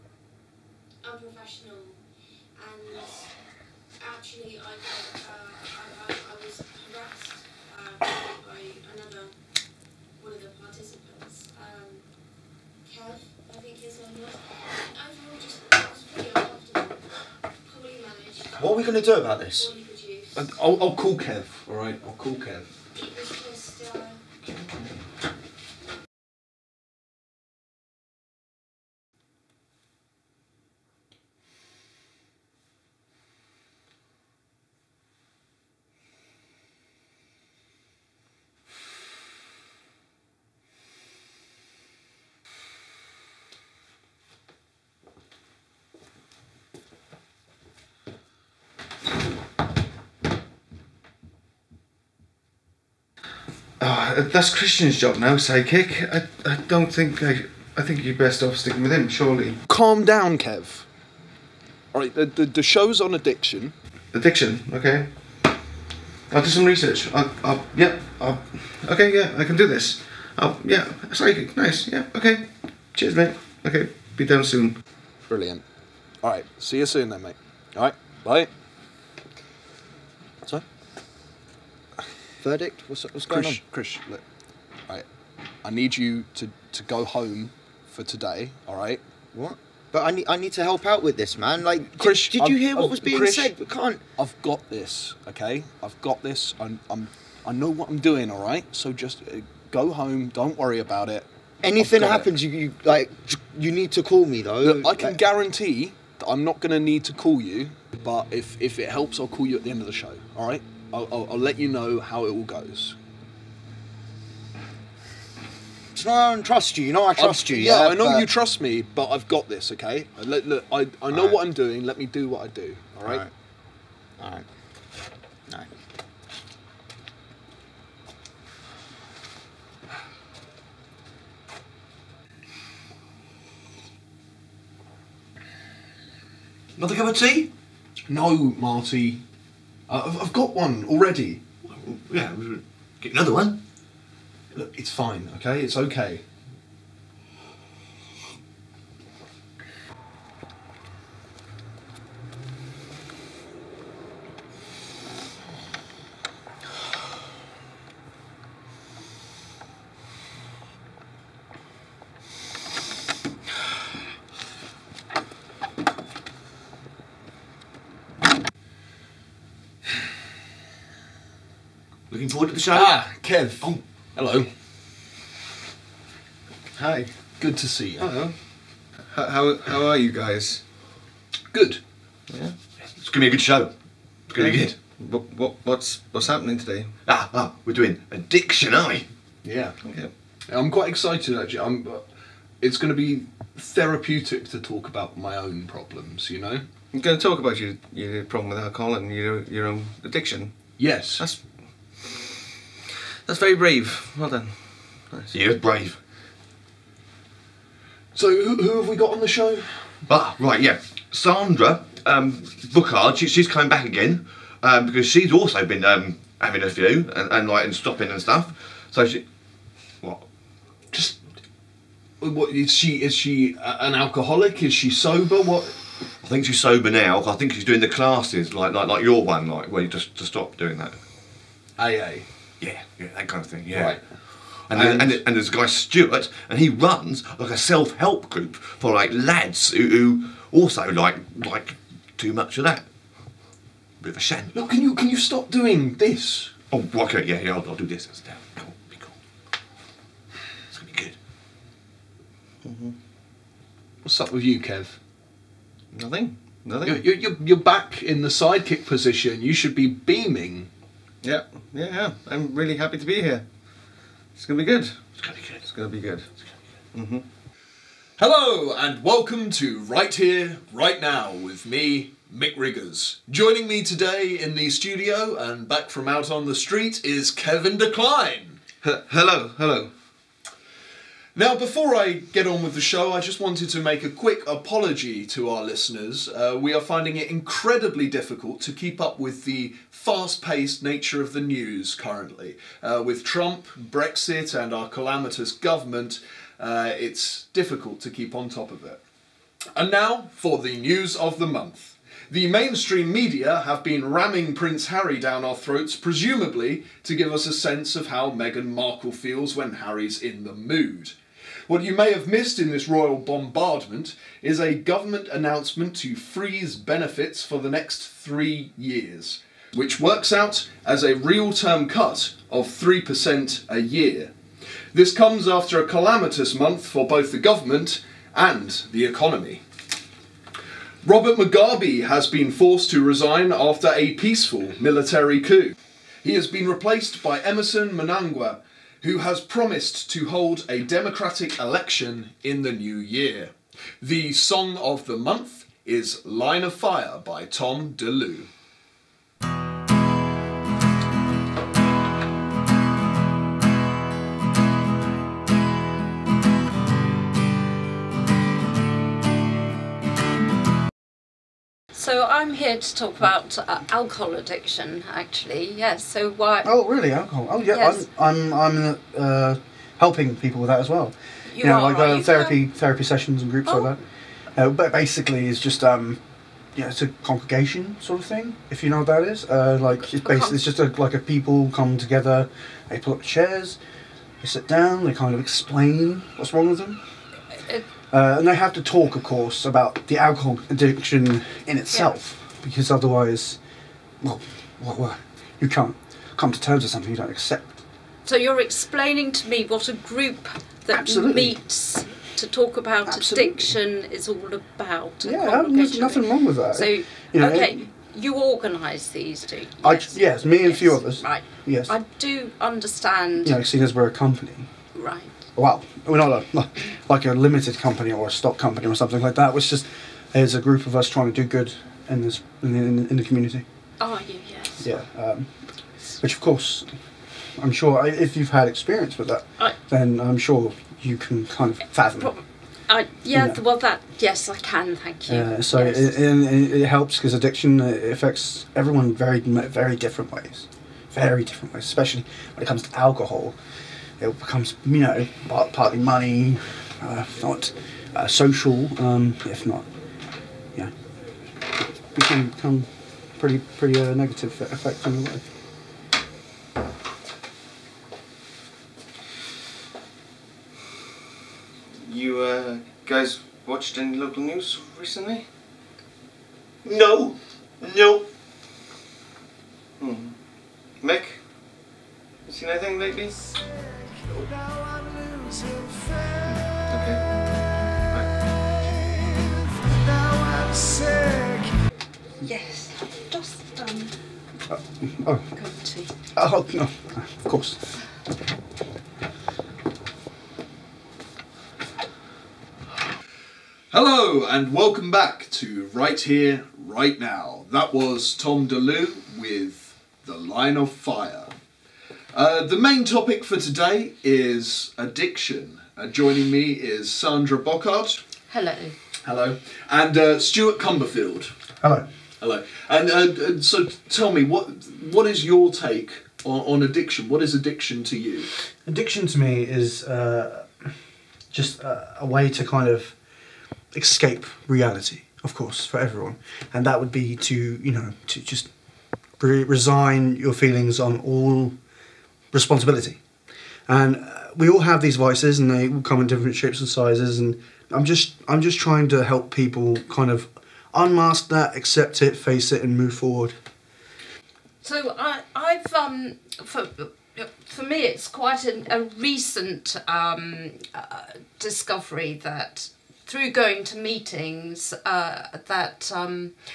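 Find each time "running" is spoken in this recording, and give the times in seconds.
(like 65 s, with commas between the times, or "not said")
not said.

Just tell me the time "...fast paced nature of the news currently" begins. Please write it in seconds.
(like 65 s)
289 s.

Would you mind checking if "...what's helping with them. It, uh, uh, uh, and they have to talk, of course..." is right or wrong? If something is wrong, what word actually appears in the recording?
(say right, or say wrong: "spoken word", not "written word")
wrong: "wrong", not "helping".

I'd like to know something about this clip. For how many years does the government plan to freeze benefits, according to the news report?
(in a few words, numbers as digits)
3.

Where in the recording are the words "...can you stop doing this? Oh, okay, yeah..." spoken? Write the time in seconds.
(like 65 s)
244 s.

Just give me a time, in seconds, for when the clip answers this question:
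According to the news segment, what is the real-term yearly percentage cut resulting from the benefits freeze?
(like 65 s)
322 s.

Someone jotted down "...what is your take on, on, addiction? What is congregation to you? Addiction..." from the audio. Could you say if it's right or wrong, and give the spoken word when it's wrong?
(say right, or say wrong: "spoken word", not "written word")
wrong: "addiction", not "congregation".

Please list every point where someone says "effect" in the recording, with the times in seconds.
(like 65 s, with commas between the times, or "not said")
454 s.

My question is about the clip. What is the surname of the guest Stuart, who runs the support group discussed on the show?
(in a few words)
Cumberfield.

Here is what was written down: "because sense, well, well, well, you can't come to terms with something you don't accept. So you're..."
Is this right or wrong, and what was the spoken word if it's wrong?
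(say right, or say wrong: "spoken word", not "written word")
wrong: "otherwise", not "sense".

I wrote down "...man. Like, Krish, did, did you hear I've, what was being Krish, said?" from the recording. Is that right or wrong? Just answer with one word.
right.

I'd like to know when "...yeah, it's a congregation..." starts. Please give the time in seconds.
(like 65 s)
376 s.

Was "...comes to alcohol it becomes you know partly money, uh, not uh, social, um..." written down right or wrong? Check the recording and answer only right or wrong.
right.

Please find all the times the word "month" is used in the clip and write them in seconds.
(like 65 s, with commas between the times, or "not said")
301 s, 326 s, 345 s.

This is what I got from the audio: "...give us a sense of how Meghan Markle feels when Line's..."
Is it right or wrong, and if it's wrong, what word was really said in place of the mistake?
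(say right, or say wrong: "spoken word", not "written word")
wrong: "Harry", not "Line".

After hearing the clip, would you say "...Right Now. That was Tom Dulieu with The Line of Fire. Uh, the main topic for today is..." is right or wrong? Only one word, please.
right.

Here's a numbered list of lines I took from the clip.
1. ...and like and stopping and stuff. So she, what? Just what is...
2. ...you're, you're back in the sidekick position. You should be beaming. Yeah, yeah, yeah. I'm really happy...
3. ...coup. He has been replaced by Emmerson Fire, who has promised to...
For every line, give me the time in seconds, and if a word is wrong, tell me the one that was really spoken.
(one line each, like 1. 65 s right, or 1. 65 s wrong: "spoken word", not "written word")
1. 217 s right
2. 257 s right
3. 335 s wrong: "Mnangagwa", not "Fire".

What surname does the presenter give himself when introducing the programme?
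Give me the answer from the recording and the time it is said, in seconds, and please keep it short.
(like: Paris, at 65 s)
Riggers, at 272 s.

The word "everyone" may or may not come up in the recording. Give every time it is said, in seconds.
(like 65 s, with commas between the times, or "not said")
438 s, 525 s.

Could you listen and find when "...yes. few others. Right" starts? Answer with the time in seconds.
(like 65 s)
410 s.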